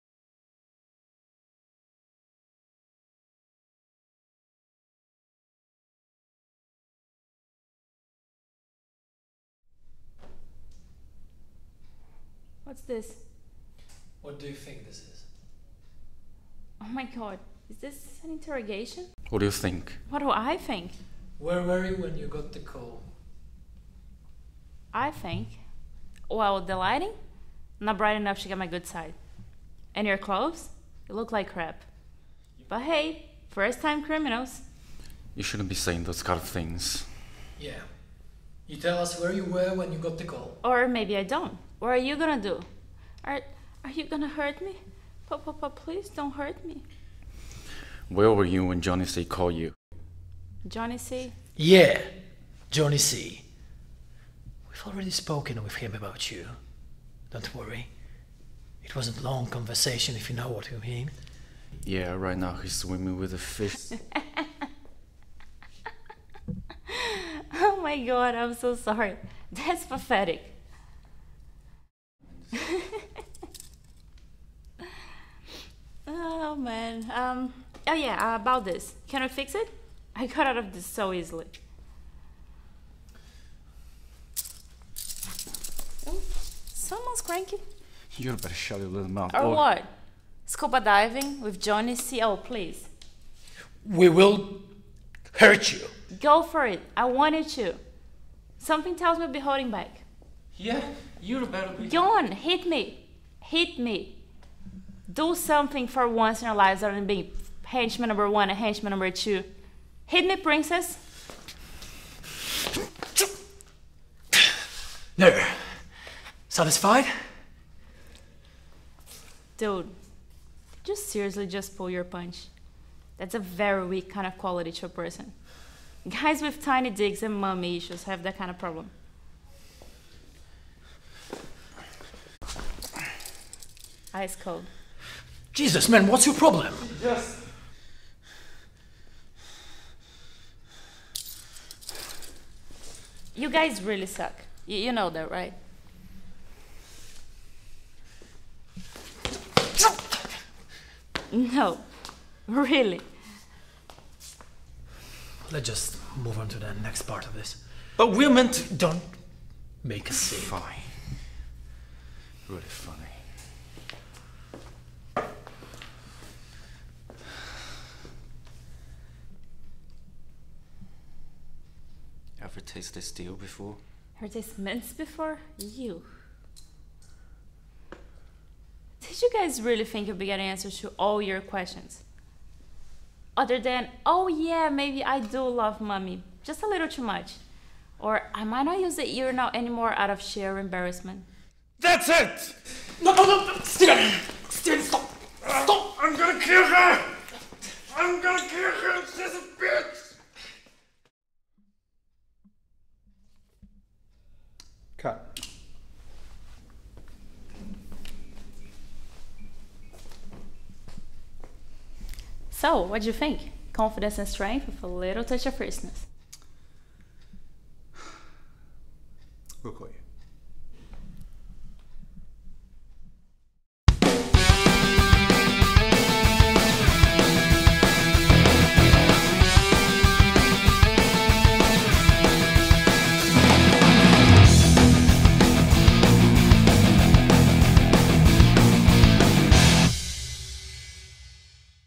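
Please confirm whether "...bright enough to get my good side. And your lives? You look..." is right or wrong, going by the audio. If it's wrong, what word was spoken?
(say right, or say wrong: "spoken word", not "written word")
wrong: "clothes", not "lives".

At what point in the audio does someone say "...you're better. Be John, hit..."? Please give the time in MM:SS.
01:41.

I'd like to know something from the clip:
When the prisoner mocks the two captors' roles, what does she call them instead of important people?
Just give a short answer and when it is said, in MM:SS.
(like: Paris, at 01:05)
henchman number one, at 01:47.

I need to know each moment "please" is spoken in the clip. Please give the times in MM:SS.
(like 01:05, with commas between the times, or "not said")
00:45, 01:32.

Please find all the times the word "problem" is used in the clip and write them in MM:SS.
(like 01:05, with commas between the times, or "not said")
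02:08, 02:16.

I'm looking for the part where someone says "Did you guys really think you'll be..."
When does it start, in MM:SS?
02:59.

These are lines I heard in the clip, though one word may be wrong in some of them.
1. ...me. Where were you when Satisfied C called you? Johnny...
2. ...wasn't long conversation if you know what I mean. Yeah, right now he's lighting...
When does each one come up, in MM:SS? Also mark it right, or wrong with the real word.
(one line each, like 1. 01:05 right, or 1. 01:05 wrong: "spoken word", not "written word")
1. 00:46 wrong: "Johnny", not "Satisfied"
2. 00:58 wrong: "swimming", not "lighting".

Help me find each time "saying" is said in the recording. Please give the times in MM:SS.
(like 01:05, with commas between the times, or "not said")
00:35.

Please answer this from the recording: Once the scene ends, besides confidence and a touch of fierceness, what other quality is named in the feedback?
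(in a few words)
strength.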